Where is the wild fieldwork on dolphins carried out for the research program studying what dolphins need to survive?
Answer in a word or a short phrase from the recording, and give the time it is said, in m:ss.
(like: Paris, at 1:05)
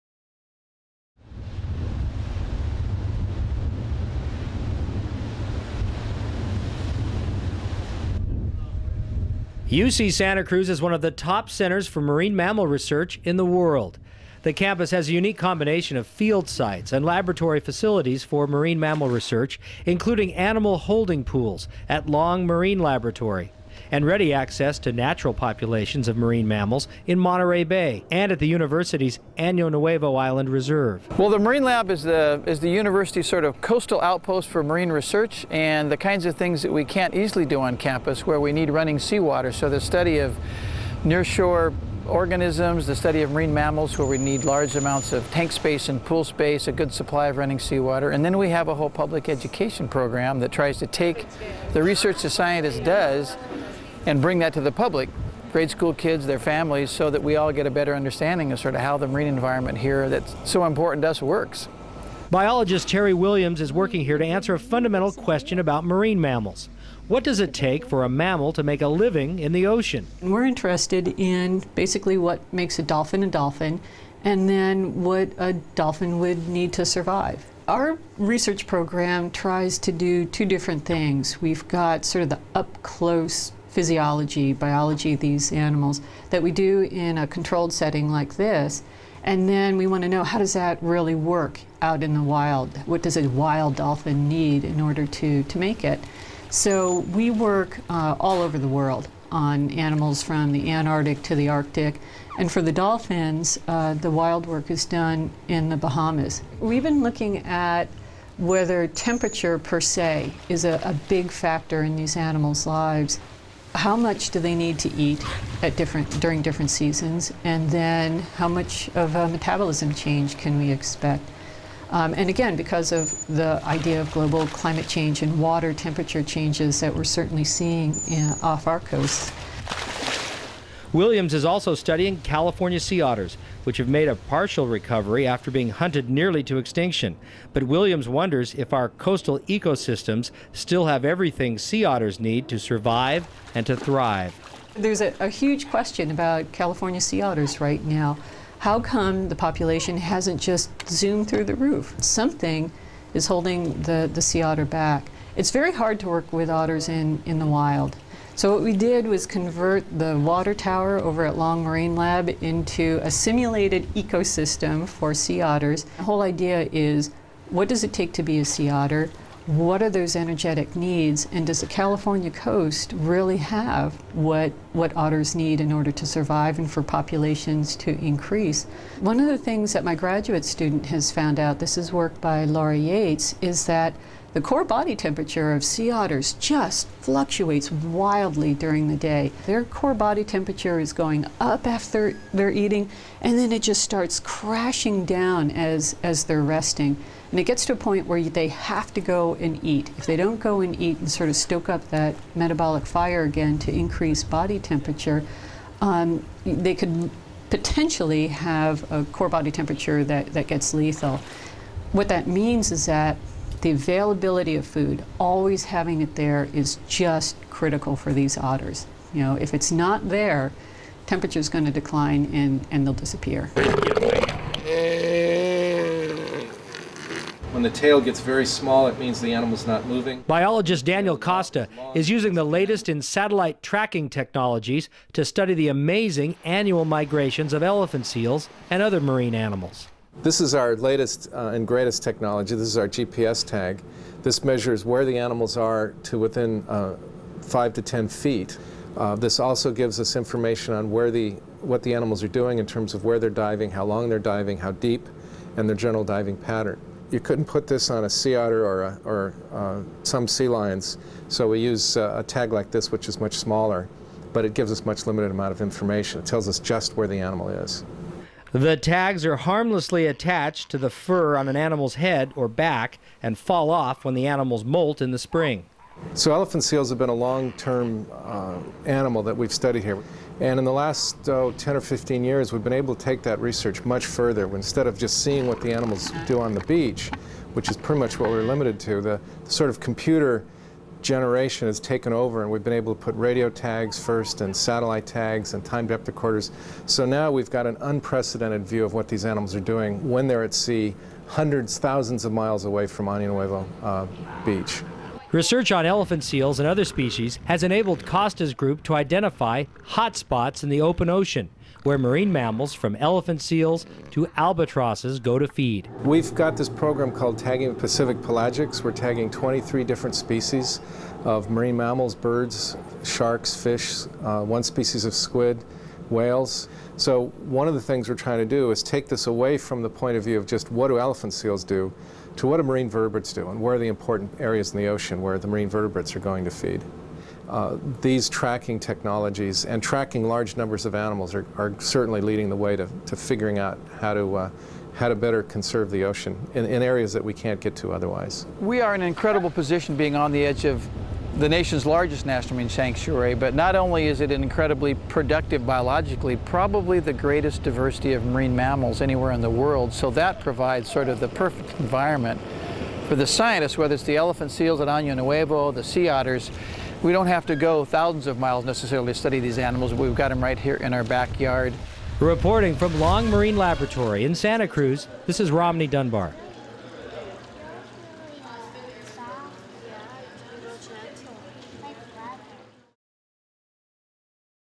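The Bahamas, at 1:45.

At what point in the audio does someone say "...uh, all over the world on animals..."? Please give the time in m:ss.
1:37.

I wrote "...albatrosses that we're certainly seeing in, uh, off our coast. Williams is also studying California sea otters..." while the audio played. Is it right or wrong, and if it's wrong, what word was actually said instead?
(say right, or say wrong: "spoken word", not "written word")
wrong: "changes", not "albatrosses".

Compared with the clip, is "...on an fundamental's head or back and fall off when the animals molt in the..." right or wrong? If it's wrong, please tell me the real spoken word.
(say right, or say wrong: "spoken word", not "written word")
wrong: "animal", not "fundamental".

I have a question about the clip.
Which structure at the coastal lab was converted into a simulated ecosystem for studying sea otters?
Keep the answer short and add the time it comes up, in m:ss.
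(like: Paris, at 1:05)
The water tower, at 2:40.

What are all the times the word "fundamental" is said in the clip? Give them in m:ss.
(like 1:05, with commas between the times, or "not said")
1:04.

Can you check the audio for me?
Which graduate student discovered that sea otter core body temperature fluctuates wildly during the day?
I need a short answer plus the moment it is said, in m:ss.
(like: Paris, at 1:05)
Laura Yeates, at 3:02.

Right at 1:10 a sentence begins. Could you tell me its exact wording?
We're interested in basically what makes a dolphin a dolphin and then what a dolphin would need to survive.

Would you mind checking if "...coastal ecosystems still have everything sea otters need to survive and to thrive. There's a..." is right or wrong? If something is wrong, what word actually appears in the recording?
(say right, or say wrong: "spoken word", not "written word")
right.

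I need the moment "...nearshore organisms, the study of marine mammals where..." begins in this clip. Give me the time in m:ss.
0:41.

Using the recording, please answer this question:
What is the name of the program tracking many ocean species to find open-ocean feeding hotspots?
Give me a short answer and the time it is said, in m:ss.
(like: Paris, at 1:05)
Tagging Pacific Pelagics, at 5:17.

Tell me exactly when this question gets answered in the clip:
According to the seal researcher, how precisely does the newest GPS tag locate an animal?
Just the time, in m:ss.
4:07.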